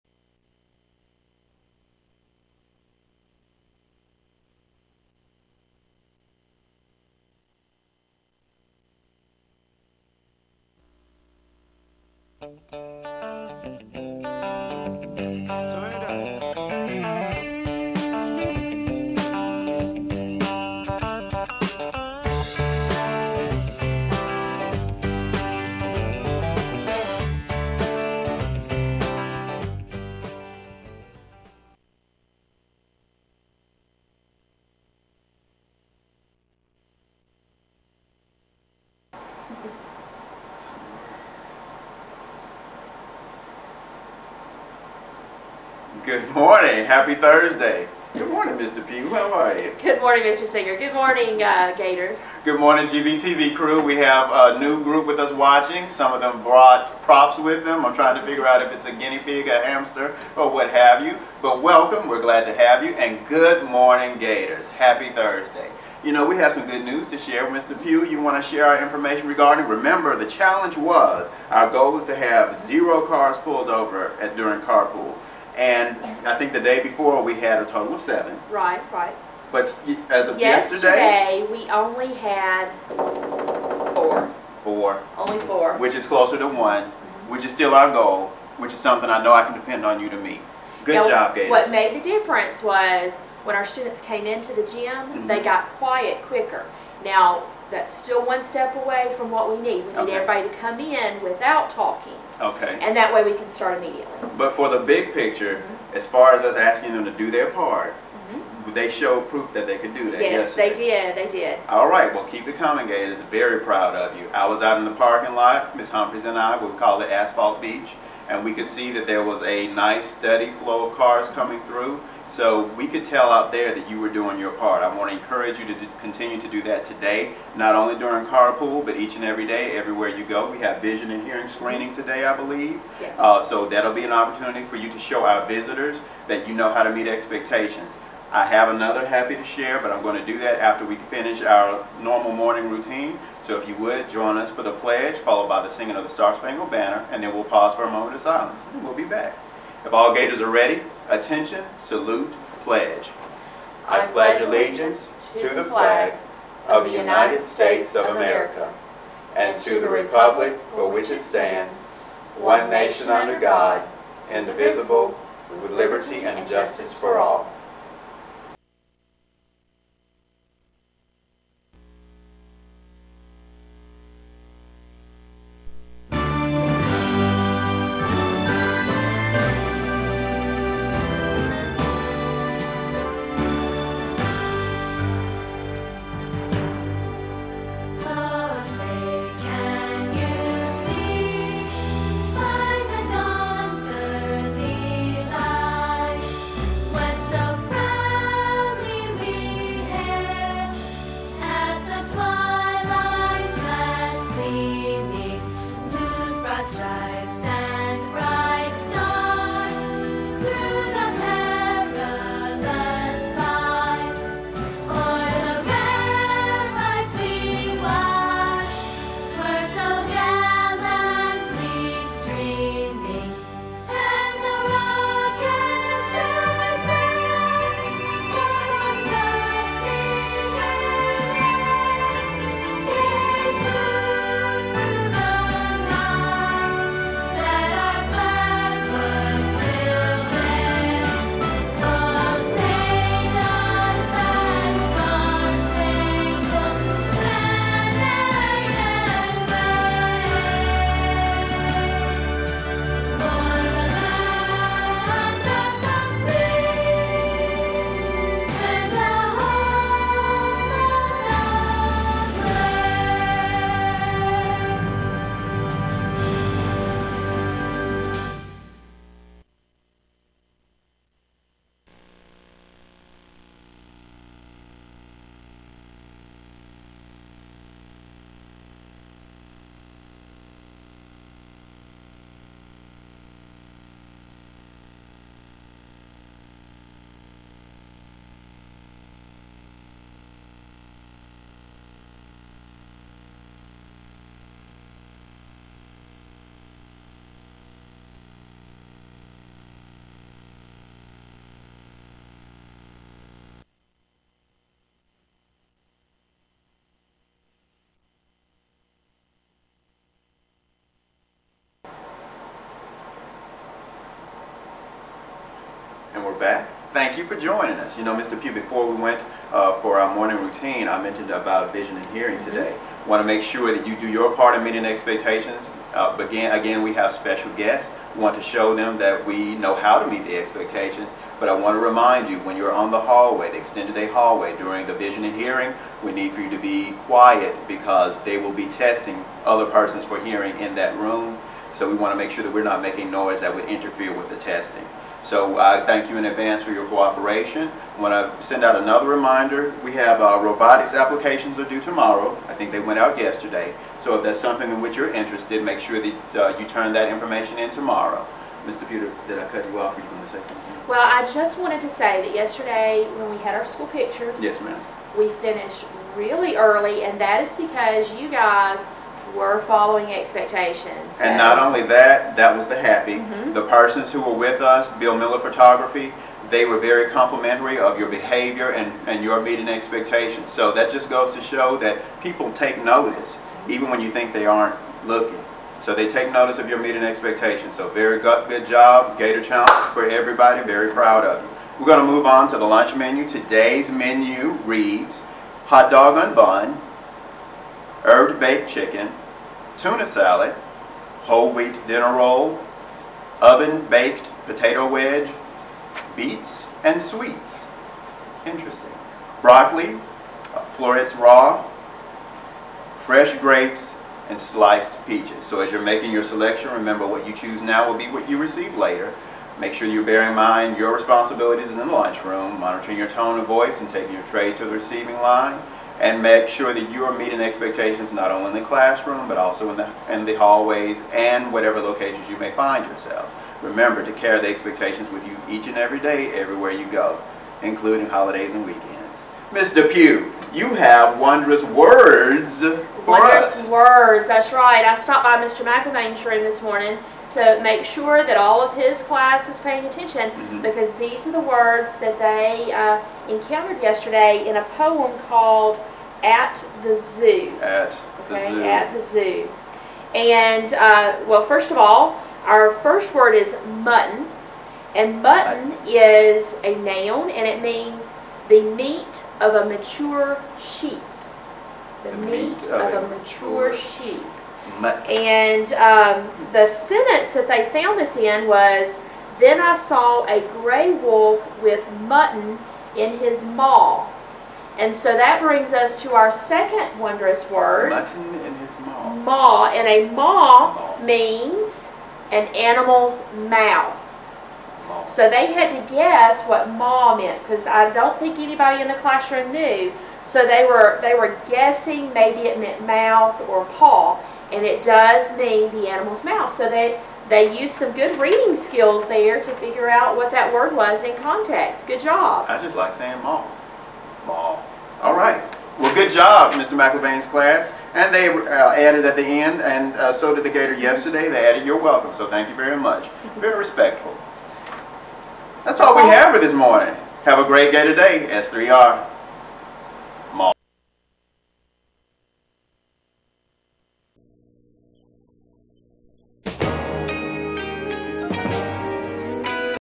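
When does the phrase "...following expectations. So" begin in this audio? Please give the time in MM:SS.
06:09.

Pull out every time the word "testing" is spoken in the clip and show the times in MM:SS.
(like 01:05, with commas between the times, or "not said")
05:38, 05:44.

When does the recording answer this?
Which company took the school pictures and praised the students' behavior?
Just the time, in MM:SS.
06:14.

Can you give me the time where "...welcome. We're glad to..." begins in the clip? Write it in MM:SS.
01:01.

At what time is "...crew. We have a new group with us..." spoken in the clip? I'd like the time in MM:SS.
00:53.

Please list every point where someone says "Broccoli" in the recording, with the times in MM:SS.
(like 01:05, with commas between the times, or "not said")
06:49.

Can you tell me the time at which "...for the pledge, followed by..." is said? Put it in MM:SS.
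02:24.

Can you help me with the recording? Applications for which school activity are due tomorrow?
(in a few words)
Robotics.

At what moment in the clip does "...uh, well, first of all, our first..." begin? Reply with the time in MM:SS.
07:40.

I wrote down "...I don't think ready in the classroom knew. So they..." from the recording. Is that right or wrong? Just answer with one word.
wrong.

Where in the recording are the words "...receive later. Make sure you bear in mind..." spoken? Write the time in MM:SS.
06:58.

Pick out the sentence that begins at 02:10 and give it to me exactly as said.
We have vision and hearing screening today, I believe.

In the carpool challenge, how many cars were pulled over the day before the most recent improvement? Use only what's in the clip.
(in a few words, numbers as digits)
7.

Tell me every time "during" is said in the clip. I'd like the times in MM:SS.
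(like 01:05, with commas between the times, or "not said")
01:14, 02:07, 05:34.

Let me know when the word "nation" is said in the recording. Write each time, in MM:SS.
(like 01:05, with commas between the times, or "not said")
02:42.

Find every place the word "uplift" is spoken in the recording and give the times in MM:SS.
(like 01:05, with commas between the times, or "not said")
not said.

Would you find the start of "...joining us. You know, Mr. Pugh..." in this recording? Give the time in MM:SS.
05:17.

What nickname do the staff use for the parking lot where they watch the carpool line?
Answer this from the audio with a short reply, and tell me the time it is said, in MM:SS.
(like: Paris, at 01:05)
Asphalt Beach, at 01:57.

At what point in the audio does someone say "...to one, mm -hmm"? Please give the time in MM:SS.
01:26.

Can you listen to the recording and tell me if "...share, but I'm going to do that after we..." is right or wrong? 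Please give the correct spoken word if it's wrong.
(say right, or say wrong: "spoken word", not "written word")
right.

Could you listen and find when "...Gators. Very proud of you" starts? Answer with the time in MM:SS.
01:52.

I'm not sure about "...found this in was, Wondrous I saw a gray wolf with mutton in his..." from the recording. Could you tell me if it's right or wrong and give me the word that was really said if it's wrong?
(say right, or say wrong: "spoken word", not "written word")
wrong: "Then", not "Wondrous".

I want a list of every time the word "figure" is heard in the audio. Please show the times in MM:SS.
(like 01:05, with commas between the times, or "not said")
00:58, 08:29.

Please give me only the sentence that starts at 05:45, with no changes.
So I thank you in advance for your cooperation.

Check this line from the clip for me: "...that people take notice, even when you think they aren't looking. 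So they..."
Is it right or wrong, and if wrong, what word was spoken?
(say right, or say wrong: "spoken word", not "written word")
right.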